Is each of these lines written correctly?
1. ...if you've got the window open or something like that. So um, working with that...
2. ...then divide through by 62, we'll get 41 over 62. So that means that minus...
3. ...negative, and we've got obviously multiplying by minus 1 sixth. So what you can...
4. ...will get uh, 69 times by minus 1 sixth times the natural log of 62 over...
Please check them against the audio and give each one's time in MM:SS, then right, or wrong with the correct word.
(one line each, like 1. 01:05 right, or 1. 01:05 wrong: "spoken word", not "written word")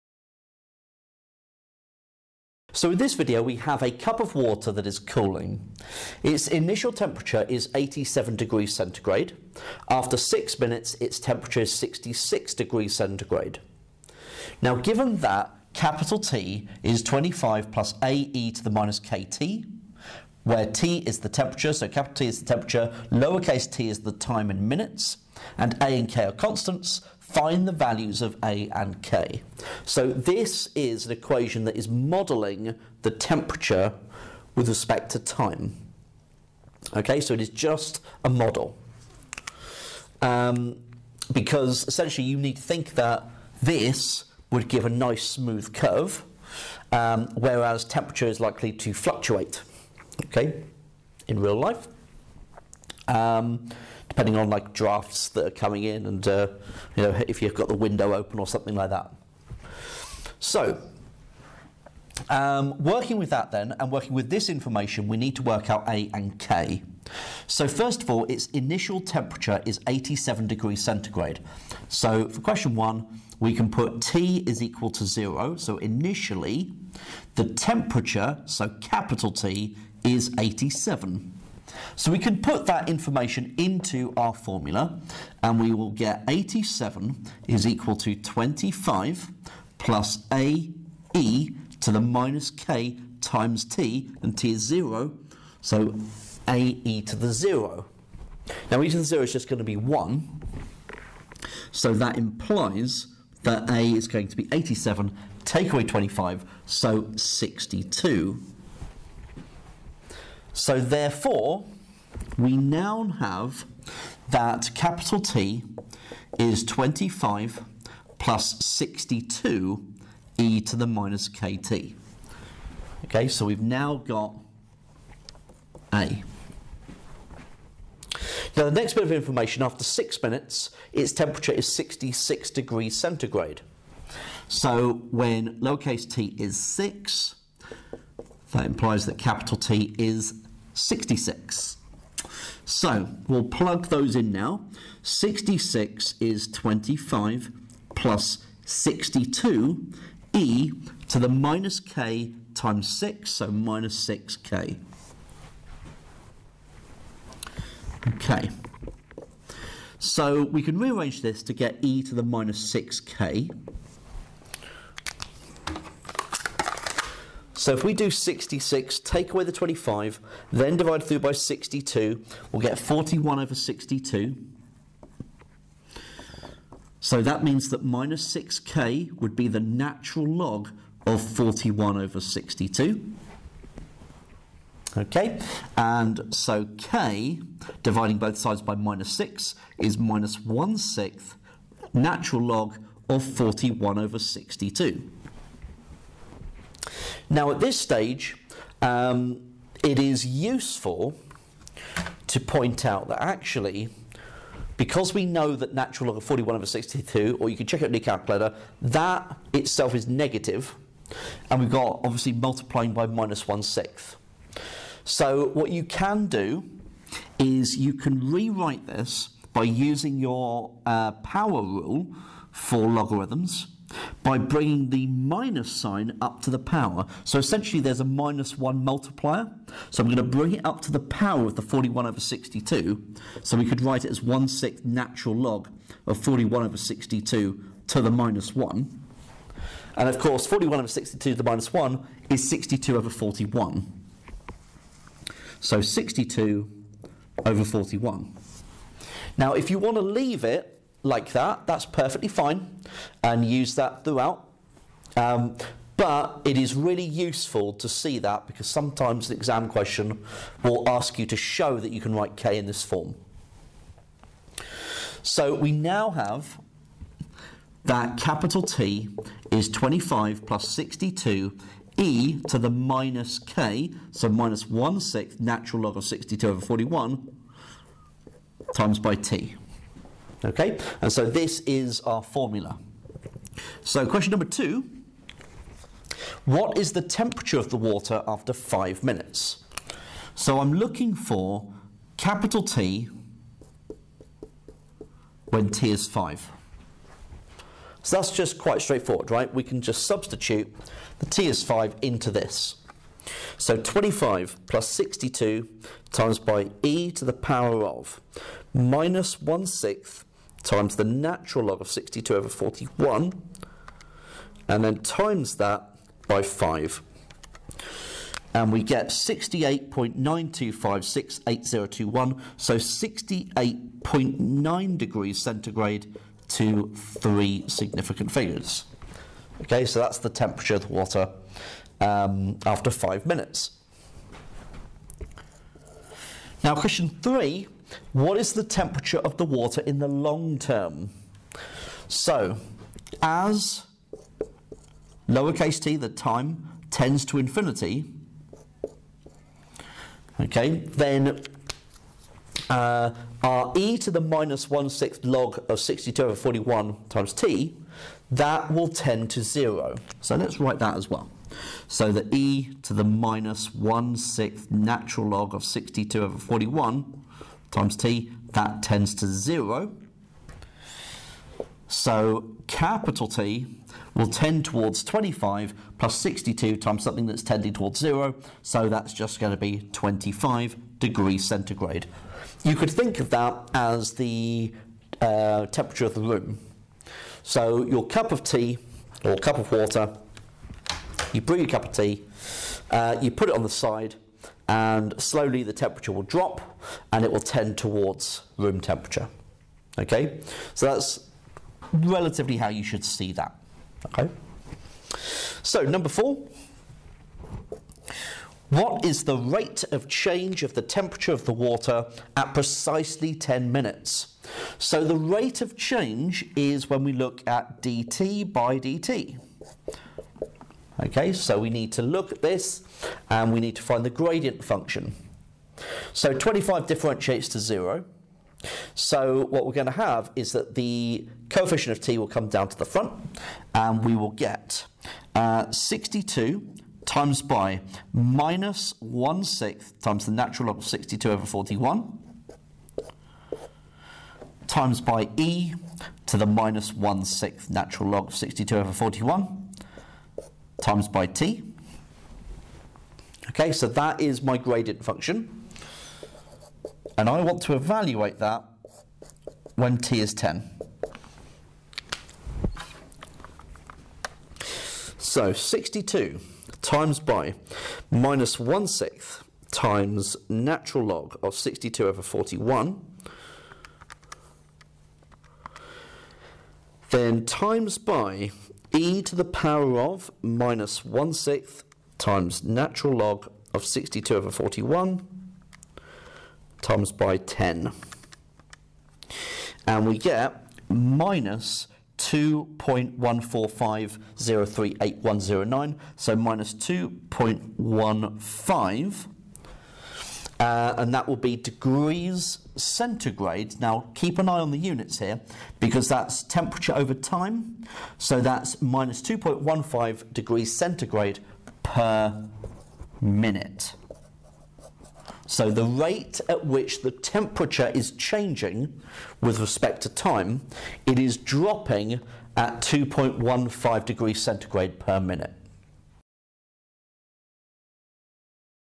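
1. 00:57 right
2. 02:50 right
3. 03:30 right
4. 07:14 wrong: "62", not "69".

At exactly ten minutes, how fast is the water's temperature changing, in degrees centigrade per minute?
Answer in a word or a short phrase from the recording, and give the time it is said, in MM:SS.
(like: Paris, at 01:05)
-2.15, at 08:28.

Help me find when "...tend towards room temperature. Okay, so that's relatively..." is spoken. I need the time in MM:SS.
06:37.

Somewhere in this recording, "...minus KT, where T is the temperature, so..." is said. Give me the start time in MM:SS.
00:18.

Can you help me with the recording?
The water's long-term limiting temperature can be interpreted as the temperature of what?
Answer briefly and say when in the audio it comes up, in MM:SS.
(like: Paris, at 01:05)
the room, at 06:26.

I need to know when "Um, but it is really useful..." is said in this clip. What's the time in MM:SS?
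04:15.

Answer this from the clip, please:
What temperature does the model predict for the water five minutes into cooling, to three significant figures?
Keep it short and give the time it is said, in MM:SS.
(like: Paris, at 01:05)
68.9 degrees centigrade, at 05:22.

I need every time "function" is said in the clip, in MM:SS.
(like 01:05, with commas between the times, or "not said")
07:04, 07:35.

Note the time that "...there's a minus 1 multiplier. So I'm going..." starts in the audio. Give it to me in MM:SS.
03:47.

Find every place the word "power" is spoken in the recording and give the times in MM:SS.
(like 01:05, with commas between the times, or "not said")
03:41, 03:46, 03:50, 05:07.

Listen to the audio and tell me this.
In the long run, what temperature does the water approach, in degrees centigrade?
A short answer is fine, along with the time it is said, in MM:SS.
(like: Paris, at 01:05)
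25, at 06:19.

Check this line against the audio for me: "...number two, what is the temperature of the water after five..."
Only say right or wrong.
right.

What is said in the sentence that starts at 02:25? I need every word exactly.
66 is 25 plus 62 e to the minus k times 6, so minus 6k.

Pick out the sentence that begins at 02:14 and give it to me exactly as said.
So when lowercase t is 6, that implies that capital T is 66.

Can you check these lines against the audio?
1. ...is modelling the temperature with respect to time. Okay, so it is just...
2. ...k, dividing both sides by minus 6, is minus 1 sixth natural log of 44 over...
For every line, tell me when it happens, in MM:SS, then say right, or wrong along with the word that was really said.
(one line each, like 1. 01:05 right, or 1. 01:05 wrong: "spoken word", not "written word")
1. 00:31 right
2. 03:06 wrong: "41", not "44".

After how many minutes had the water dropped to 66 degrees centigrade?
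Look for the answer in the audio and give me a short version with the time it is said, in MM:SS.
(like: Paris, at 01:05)
6 minutes, at 00:10.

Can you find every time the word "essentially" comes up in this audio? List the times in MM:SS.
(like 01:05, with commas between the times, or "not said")
00:41, 03:47.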